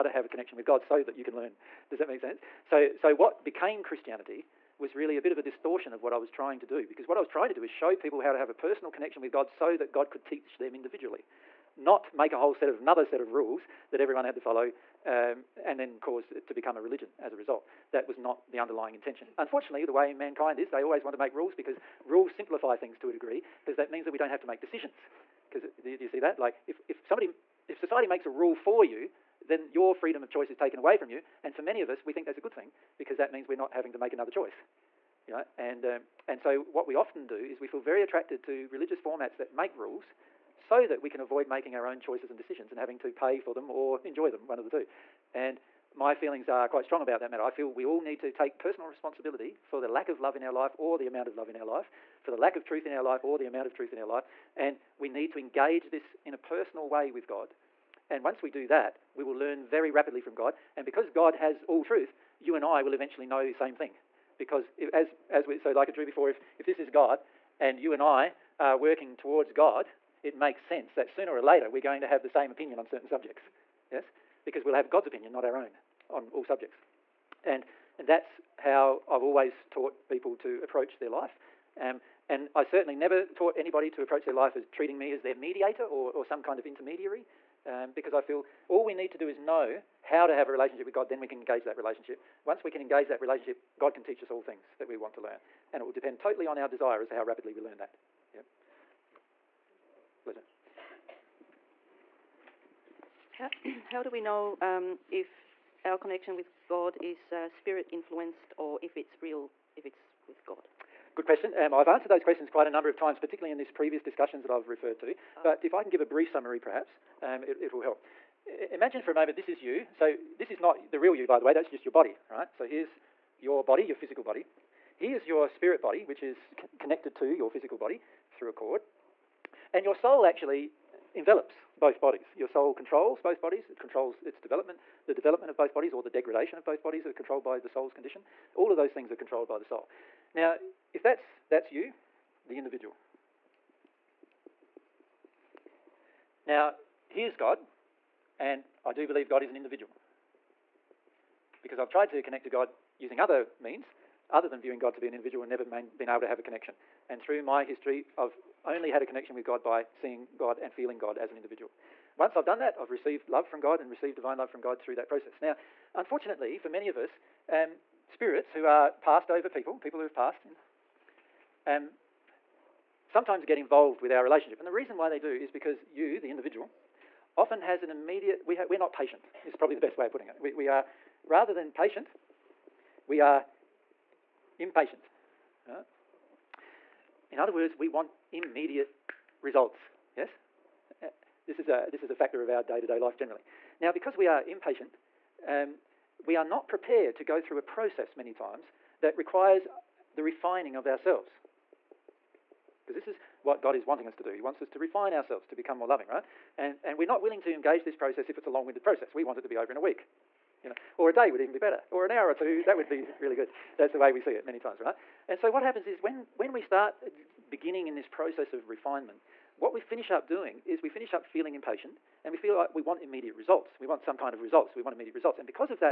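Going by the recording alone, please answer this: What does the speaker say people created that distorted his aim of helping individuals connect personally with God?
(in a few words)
Christianity.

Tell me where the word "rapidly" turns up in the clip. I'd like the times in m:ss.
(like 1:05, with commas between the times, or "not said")
0:59, 1:37.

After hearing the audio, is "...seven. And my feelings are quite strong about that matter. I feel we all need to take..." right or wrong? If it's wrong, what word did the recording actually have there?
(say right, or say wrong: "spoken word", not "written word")
wrong: "two", not "seven".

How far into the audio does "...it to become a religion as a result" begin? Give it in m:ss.
0:16.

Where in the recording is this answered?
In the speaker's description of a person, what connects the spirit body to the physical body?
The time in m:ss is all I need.
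2:08.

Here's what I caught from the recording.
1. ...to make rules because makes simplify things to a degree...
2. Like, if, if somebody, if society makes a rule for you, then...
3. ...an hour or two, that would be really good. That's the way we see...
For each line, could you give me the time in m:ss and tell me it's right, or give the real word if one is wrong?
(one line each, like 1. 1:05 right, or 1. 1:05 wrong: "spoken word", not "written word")
1. 0:21 wrong: "rules", not "makes"
2. 0:26 right
3. 3:32 right.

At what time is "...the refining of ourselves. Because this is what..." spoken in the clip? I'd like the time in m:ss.
3:20.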